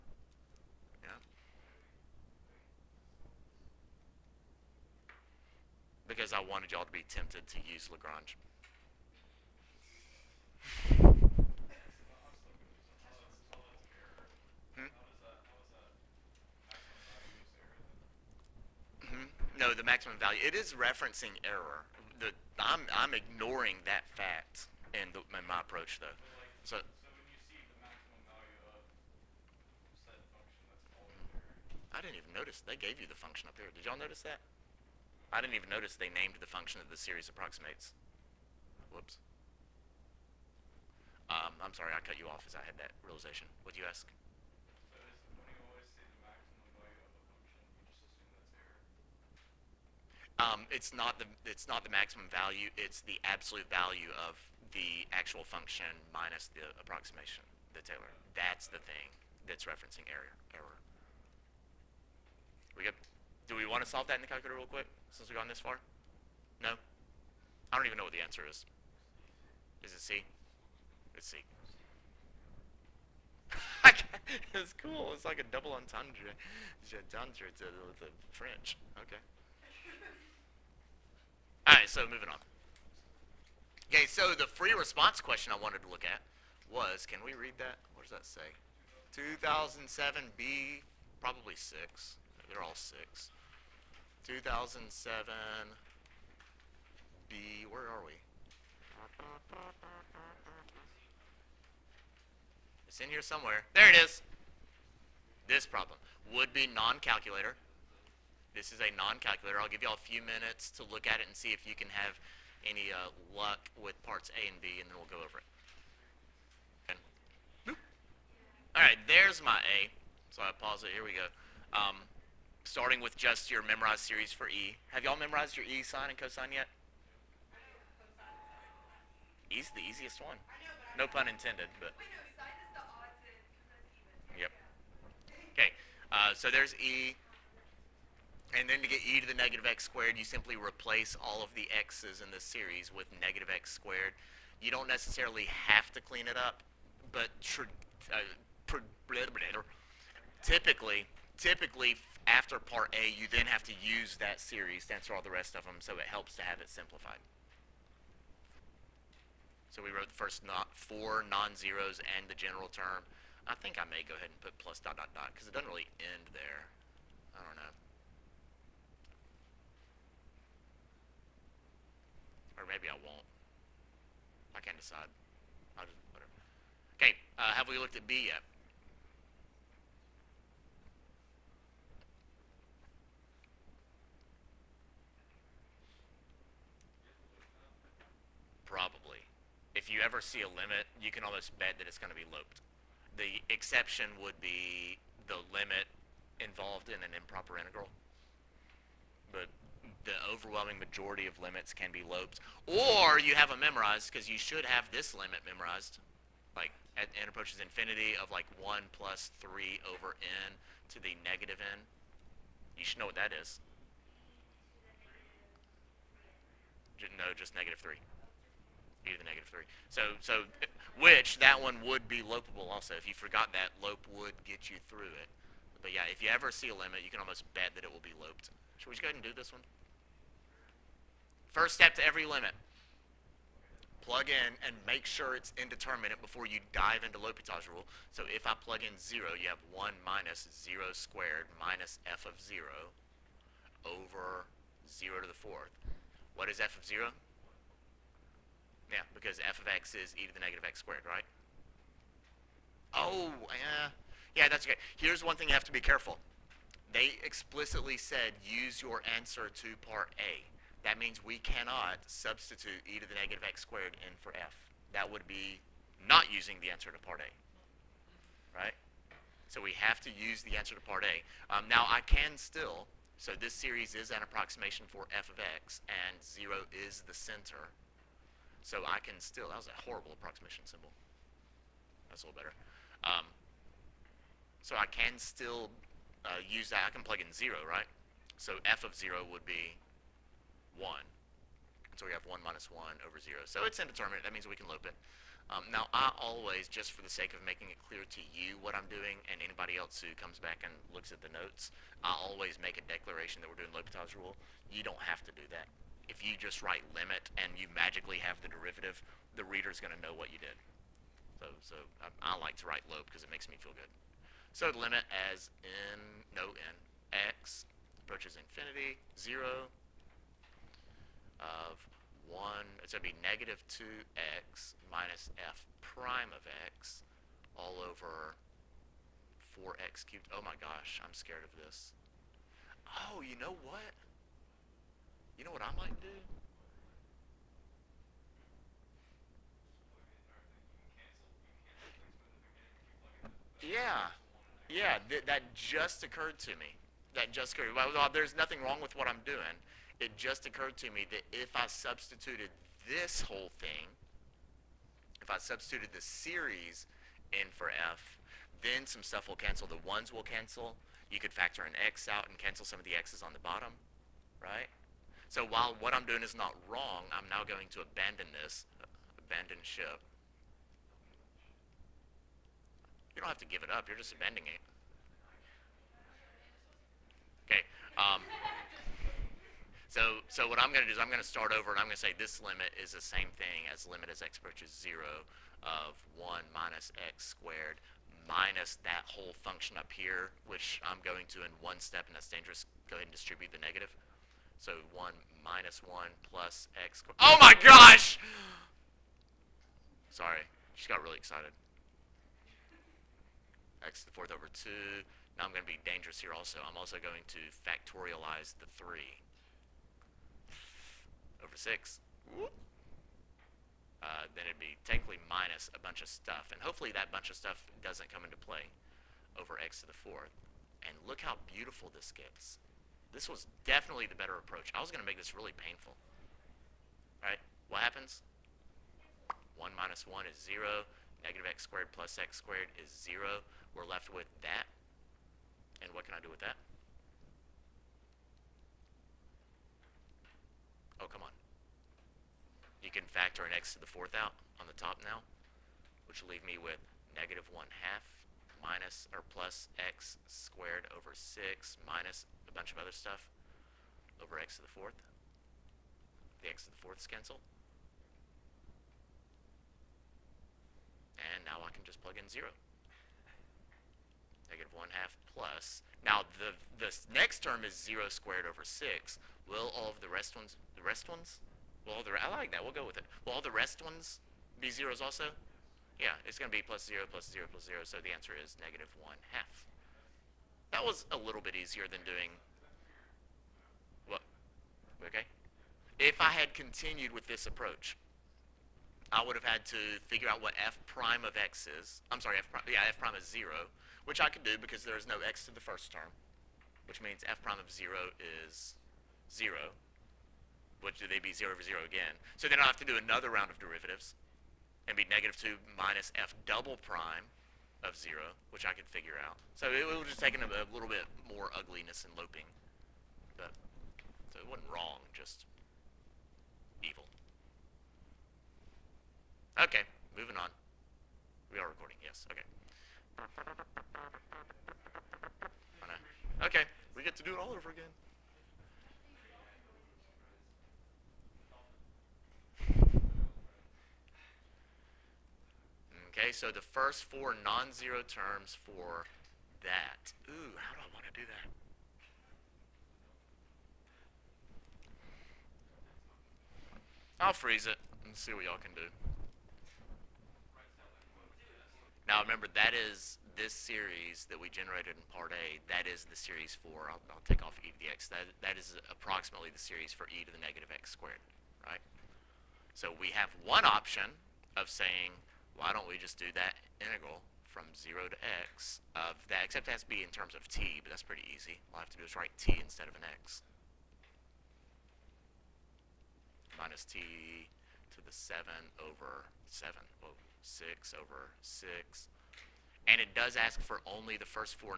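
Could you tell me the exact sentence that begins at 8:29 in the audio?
So it, it was just taking a, a little bit more ugliness and loping.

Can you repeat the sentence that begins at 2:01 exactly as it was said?
Um, starting with just your memorized series for E.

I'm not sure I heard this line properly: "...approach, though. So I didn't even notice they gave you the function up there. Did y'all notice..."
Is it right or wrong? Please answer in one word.
right.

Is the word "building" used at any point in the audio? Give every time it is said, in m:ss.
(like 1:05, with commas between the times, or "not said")
not said.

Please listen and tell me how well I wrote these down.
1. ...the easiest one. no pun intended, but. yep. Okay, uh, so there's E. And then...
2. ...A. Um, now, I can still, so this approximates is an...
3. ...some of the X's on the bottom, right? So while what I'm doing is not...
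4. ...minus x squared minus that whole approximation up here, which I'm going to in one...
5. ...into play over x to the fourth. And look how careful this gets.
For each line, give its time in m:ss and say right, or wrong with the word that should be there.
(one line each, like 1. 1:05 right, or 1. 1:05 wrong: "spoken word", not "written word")
1. 2:09 right
2. 4:31 wrong: "series", not "approximates"
3. 6:02 right
4. 6:26 wrong: "function", not "approximation"
5. 6:58 wrong: "beautiful", not "careful".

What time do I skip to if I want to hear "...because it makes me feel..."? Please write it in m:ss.
5:13.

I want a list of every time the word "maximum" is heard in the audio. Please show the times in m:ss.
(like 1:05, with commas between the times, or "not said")
0:19, 0:51.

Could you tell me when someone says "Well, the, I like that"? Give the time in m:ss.
7:51.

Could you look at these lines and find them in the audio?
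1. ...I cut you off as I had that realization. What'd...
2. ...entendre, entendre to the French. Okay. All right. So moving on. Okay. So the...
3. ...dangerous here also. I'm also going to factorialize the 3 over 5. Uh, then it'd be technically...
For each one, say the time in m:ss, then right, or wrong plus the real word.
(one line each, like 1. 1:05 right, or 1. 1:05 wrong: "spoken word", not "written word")
1. 0:41 right
2. 1:15 right
3. 6:45 wrong: "6", not "5".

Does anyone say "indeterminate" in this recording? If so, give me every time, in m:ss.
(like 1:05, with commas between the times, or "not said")
3:55, 4:53.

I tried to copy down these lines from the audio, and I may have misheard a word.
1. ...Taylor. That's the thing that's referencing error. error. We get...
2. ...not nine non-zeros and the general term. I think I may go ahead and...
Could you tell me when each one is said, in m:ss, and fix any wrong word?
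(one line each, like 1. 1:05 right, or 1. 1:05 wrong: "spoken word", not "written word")
1. 0:57 right
2. 2:40 wrong: "four", not "nine".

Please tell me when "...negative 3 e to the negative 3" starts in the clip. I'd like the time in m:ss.
3:37.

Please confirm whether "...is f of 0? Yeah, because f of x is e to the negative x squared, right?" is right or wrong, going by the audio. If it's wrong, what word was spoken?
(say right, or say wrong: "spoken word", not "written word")
right.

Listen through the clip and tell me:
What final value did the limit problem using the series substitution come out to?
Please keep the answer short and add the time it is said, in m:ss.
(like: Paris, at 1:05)
negative 1 half, at 7:58.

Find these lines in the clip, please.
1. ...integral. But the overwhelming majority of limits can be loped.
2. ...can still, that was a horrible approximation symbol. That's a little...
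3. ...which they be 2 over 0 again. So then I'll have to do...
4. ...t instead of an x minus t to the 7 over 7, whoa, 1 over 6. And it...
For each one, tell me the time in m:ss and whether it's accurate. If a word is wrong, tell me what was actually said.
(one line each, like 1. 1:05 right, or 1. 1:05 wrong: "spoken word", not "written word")
1. 3:17 right
2. 4:38 right
3. 8:20 wrong: "0", not "2"
4. 9:32 wrong: "6", not "1".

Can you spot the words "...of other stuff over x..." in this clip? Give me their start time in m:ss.
7:32.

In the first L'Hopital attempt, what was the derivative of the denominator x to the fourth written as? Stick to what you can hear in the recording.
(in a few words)
4x cubed.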